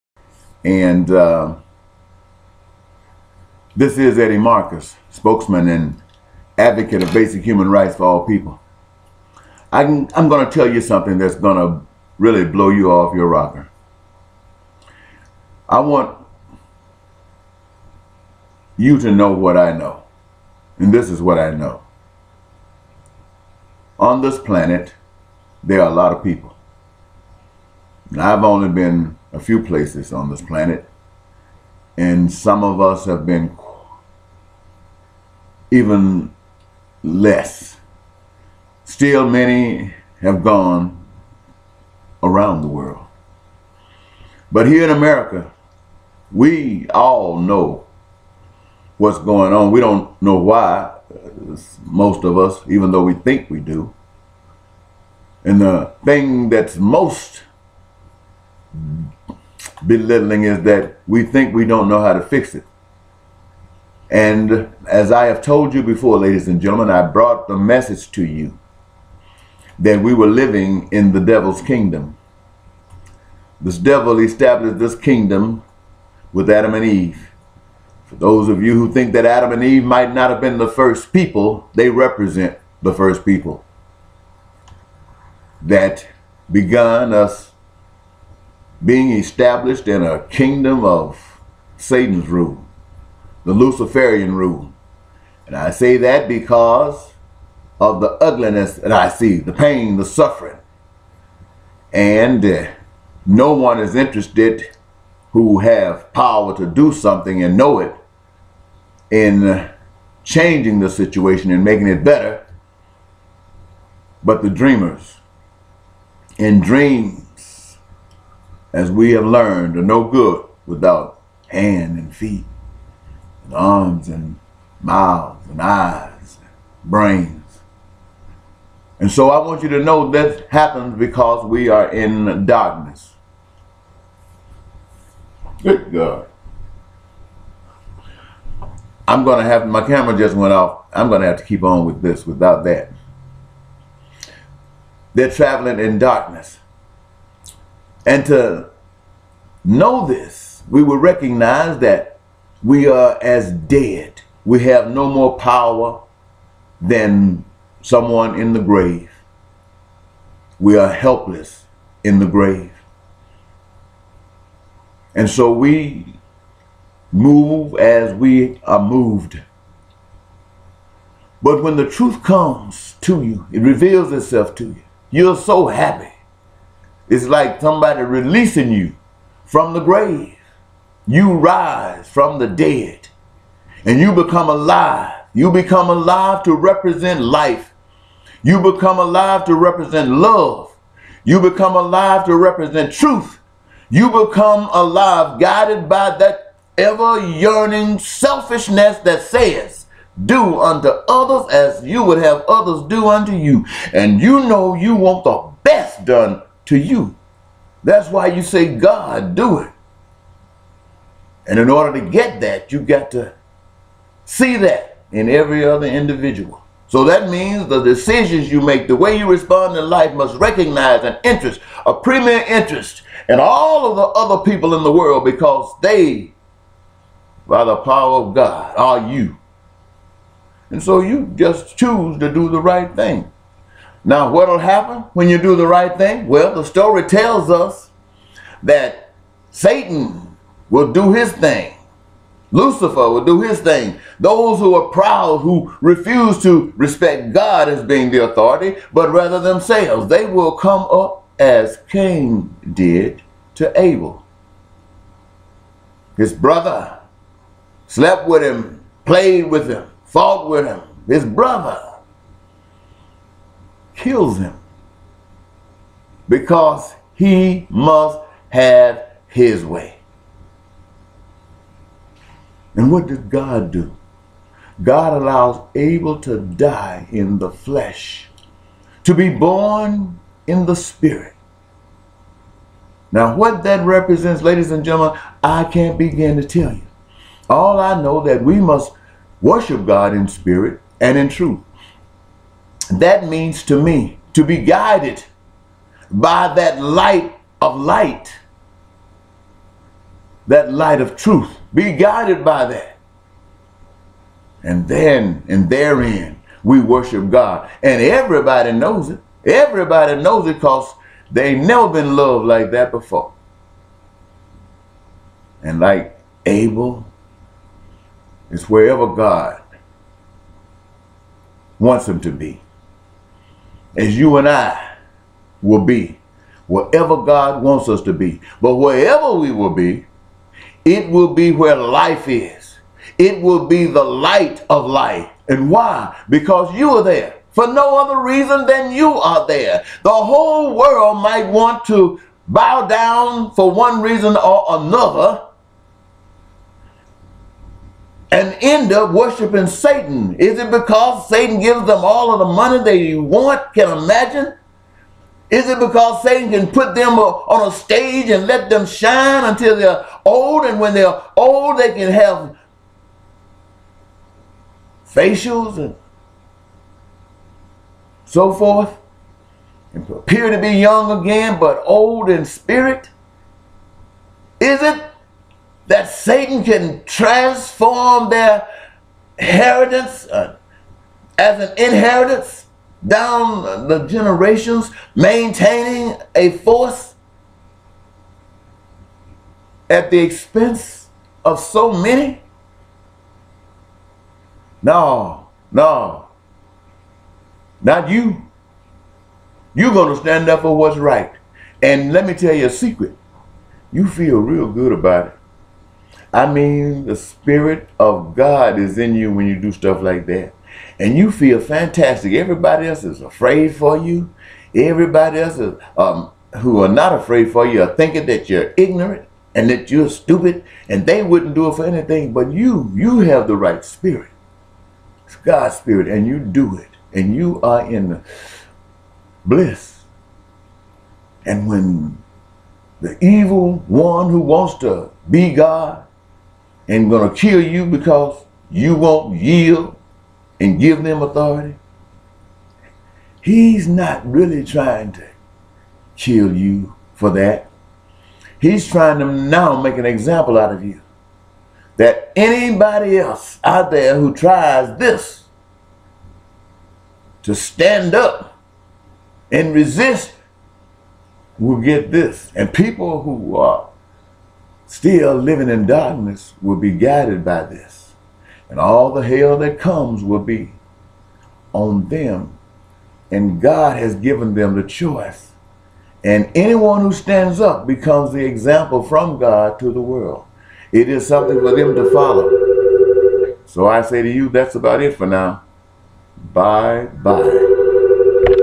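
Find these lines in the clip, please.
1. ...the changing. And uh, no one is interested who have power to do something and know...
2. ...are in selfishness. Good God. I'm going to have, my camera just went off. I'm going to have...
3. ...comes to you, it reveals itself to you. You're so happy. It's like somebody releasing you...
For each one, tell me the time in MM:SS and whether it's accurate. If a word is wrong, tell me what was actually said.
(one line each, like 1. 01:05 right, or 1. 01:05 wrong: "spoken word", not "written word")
1. 01:39 wrong: "suffering", not "changing"
2. 02:11 wrong: "darkness", not "selfishness"
3. 02:52 right.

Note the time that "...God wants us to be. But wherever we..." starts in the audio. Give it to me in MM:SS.
05:27.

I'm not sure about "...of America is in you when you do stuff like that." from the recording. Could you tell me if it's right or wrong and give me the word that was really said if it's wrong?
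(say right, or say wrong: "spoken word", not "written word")
wrong: "God", not "America".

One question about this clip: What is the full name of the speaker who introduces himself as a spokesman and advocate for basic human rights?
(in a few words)
Eddie Marcus.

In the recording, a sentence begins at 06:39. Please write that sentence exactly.
You're going to stand up for what's right.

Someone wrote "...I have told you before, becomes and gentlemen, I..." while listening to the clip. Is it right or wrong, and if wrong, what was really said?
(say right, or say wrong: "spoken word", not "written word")
wrong: "ladies", not "becomes".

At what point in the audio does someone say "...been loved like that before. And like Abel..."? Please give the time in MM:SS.
05:11.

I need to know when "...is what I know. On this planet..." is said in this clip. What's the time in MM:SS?
00:21.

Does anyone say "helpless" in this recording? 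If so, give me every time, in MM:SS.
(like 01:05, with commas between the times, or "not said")
02:40.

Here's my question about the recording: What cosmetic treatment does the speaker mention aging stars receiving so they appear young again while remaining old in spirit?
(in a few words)
Facials.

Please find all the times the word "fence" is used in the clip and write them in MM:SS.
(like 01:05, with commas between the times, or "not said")
not said.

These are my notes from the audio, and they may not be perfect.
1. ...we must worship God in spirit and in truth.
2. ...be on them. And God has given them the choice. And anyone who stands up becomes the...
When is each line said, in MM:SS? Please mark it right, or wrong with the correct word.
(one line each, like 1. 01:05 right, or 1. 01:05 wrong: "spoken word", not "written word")
1. 04:48 right
2. 07:50 right.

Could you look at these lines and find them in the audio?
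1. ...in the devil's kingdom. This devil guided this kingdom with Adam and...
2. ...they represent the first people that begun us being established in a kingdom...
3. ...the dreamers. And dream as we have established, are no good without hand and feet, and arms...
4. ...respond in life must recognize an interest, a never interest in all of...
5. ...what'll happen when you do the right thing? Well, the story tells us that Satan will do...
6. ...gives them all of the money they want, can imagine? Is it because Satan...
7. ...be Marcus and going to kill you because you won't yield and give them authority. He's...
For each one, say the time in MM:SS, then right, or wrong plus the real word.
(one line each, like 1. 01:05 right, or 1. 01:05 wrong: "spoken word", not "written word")
1. 01:10 wrong: "established", not "guided"
2. 01:21 right
3. 01:54 wrong: "learned", not "established"
4. 03:39 wrong: "premier", not "never"
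5. 03:54 right
6. 05:51 right
7. 07:15 wrong: "God", not "Marcus".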